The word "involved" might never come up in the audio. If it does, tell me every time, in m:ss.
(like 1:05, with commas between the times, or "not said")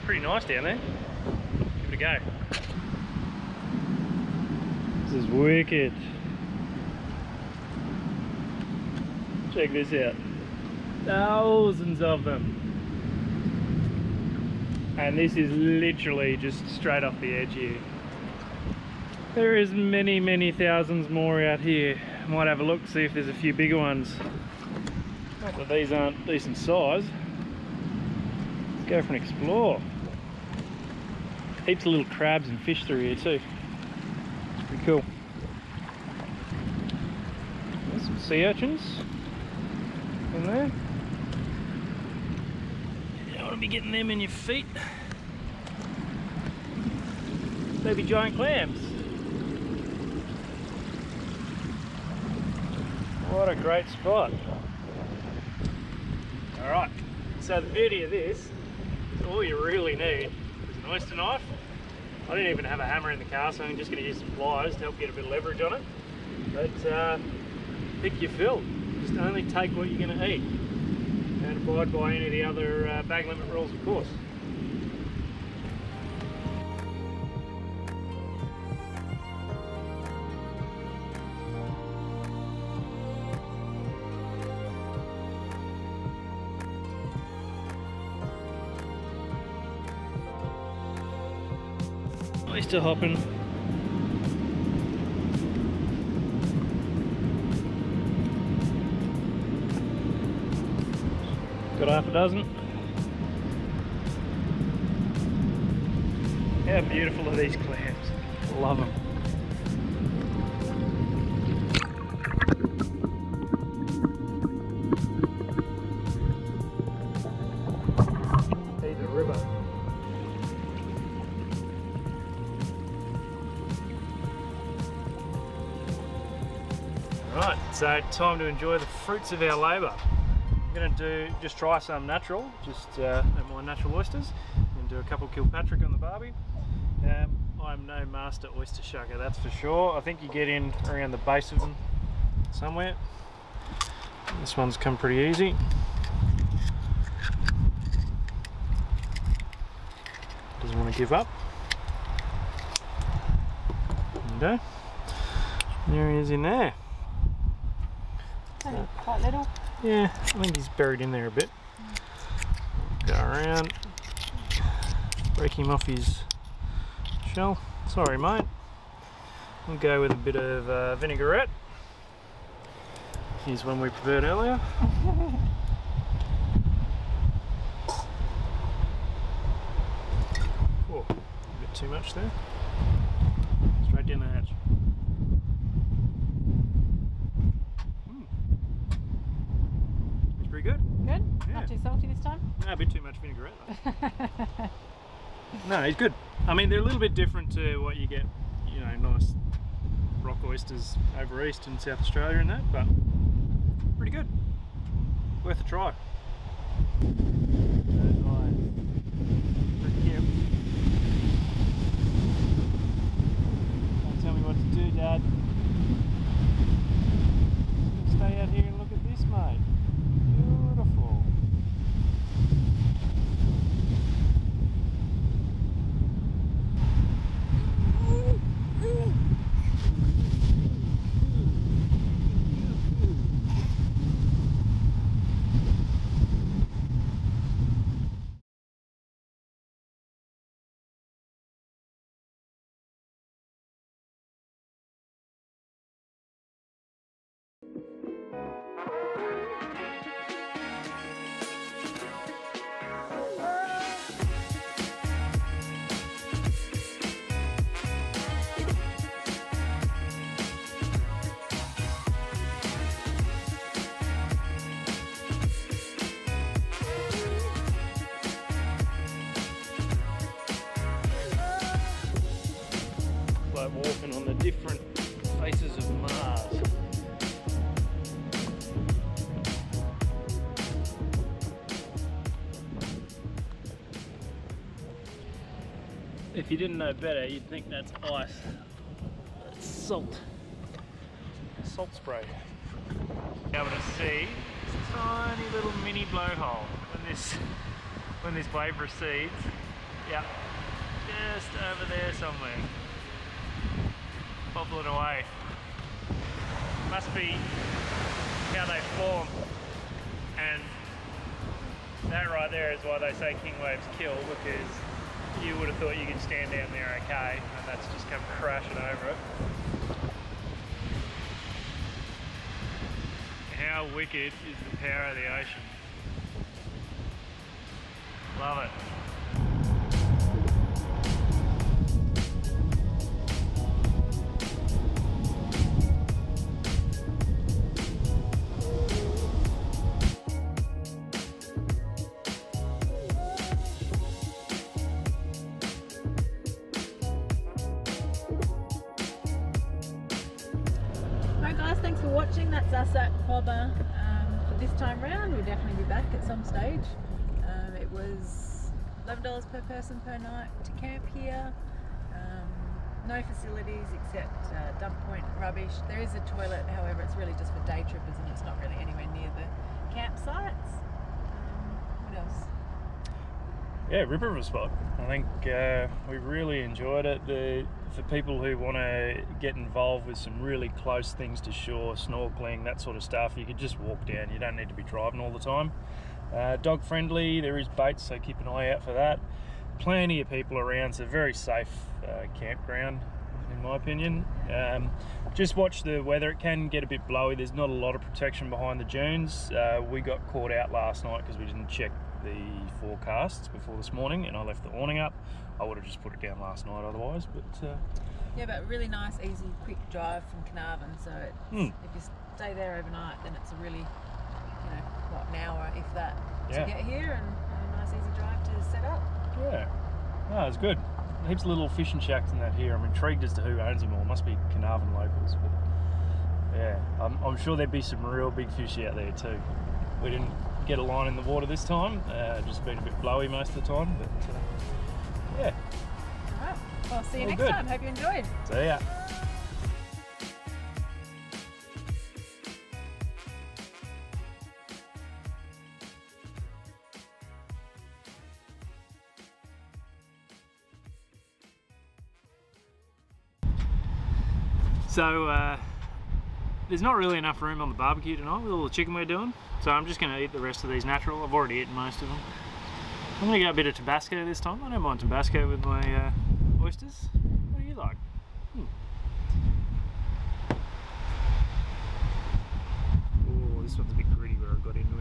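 6:19.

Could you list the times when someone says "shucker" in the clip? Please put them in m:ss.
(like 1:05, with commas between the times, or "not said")
2:18.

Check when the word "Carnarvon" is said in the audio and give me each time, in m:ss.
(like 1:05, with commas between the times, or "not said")
6:50, 7:04.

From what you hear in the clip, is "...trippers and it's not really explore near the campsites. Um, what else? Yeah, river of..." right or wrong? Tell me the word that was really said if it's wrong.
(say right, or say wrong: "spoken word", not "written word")
wrong: "anywhere", not "explore".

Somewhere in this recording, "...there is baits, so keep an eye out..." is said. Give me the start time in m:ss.
6:27.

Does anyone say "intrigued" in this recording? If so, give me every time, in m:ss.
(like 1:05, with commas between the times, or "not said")
7:02.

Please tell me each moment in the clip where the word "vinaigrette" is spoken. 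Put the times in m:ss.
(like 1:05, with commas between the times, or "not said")
2:50, 3:13.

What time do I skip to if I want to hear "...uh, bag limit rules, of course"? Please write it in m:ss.
1:12.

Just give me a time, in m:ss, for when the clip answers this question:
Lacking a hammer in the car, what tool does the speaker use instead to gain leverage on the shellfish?
1:04.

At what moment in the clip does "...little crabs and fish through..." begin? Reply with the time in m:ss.
0:31.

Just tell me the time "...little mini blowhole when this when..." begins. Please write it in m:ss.
4:55.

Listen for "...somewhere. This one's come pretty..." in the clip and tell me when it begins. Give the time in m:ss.
2:22.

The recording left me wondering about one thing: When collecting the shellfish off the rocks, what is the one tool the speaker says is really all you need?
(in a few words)
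Oyster knife.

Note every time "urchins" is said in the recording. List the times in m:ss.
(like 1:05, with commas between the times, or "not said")
0:38.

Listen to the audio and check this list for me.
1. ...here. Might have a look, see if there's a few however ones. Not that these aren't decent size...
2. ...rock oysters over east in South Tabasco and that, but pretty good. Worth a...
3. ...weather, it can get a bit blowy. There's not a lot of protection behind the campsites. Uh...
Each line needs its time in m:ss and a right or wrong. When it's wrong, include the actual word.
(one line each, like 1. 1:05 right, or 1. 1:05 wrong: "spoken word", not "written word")
1. 0:21 wrong: "bigger", not "however"
2. 3:20 wrong: "Australia", not "Tabasco"
3. 6:35 wrong: "dunes", not "campsites".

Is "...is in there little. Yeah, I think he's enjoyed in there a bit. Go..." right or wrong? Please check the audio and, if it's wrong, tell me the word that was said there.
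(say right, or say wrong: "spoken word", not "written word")
wrong: "buried", not "enjoyed".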